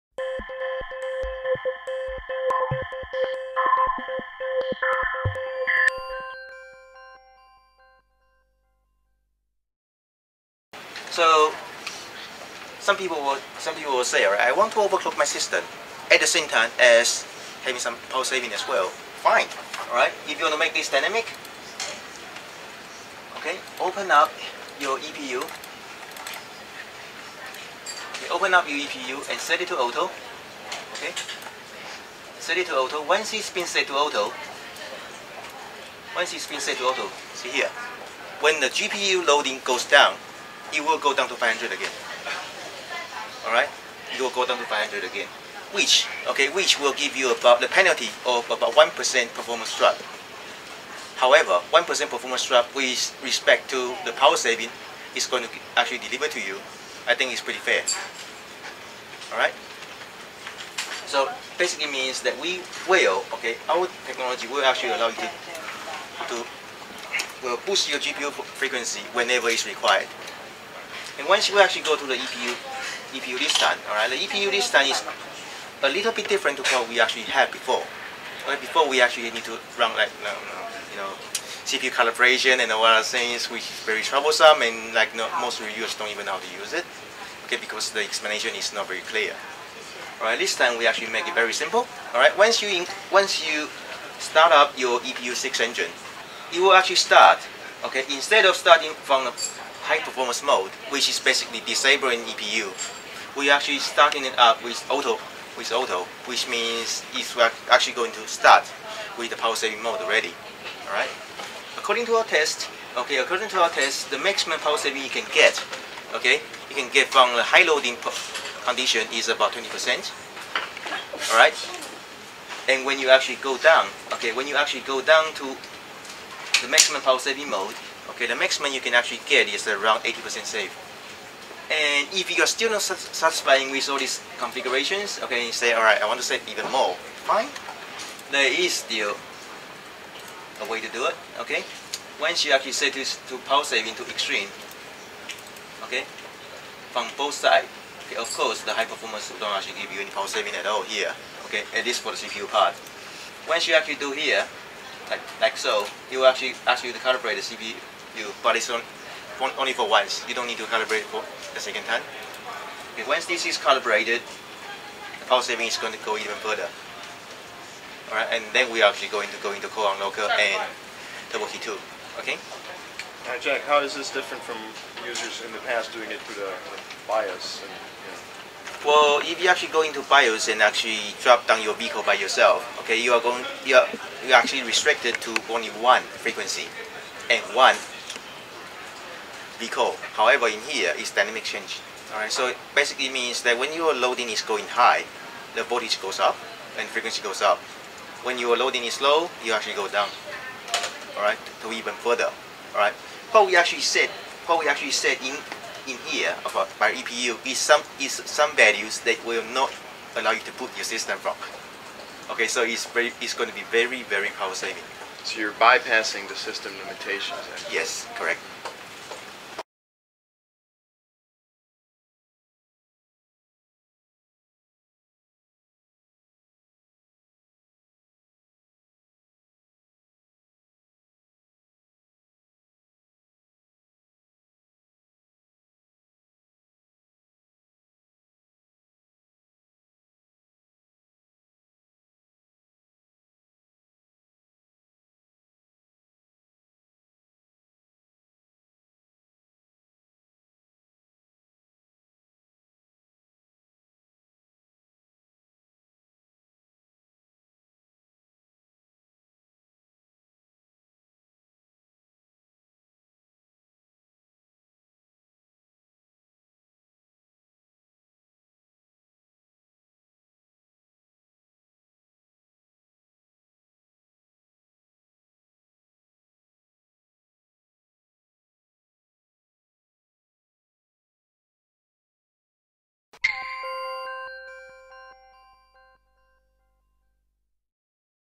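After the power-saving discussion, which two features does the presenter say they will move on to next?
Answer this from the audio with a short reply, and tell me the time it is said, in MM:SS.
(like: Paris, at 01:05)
Core Unlocker and Turbo Key 2, at 02:49.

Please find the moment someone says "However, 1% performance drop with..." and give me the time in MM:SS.
00:51.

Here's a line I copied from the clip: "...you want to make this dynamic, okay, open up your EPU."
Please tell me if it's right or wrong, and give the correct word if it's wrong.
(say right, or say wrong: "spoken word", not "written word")
right.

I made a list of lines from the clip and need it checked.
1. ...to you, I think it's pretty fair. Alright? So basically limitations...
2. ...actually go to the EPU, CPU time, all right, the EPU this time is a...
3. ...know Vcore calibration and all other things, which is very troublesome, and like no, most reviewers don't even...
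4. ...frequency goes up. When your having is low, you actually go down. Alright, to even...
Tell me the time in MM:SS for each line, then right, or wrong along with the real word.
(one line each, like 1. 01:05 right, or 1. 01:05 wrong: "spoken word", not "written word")
1. 00:56 wrong: "means", not "limitations"
2. 01:11 wrong: "EPU", not "CPU"
3. 01:20 wrong: "CPU", not "Vcore"
4. 03:16 wrong: "loading", not "having".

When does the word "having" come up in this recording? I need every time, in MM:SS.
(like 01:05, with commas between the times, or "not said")
00:17.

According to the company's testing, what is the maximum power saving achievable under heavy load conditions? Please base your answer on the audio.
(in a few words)
20%.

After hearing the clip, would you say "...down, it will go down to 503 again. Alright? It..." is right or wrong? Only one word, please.
wrong.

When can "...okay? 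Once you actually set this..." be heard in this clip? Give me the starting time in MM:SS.
02:21.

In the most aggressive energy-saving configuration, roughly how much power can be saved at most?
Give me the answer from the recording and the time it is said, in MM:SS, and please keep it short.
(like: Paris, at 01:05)
80%, at 02:09.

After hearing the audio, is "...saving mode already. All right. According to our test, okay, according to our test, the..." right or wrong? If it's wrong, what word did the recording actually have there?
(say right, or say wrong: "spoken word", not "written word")
right.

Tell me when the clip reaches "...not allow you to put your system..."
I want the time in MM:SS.
03:29.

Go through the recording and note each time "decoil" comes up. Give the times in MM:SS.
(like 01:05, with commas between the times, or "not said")
03:09.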